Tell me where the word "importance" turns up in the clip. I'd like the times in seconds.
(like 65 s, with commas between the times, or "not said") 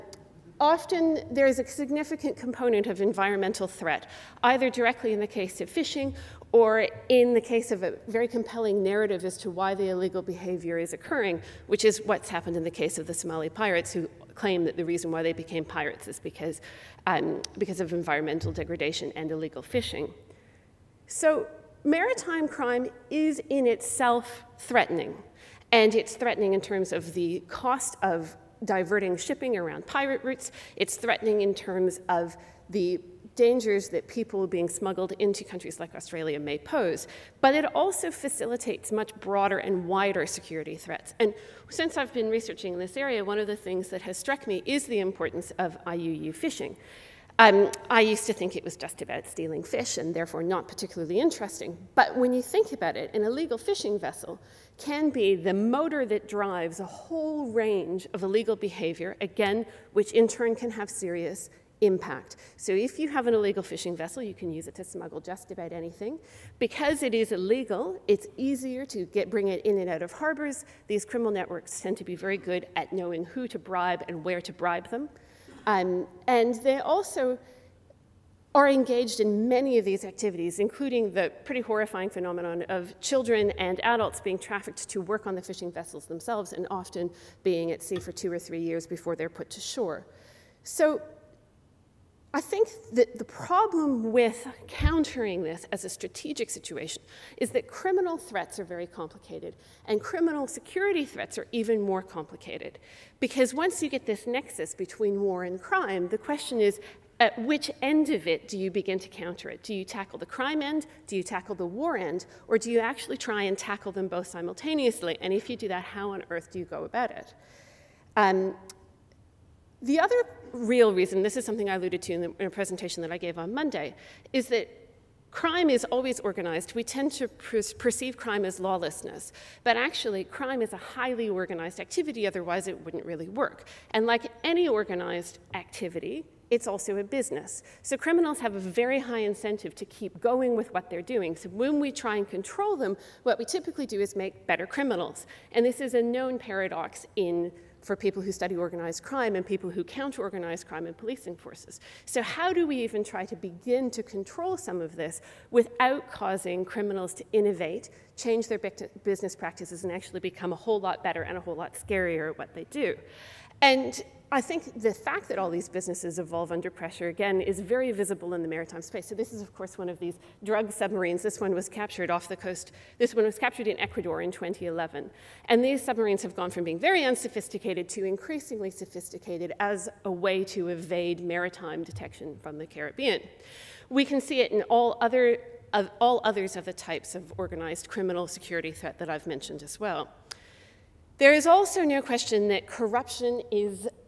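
44 s.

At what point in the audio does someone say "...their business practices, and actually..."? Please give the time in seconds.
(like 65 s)
158 s.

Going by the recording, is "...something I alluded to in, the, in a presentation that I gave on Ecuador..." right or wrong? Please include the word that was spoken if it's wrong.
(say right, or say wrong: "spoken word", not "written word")
wrong: "Monday", not "Ecuador".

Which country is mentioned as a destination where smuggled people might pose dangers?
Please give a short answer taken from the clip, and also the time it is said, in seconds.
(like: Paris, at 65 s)
Australia, at 35 s.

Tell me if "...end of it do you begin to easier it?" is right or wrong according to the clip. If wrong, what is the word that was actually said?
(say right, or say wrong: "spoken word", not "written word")
wrong: "counter", not "easier".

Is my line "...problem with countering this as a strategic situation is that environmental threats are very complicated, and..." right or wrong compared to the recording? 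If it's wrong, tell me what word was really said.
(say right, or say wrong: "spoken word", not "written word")
wrong: "criminal", not "environmental".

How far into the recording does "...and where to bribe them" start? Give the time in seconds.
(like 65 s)
74 s.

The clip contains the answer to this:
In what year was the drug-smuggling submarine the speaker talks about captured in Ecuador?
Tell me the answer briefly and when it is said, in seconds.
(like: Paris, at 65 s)
2011, at 174 s.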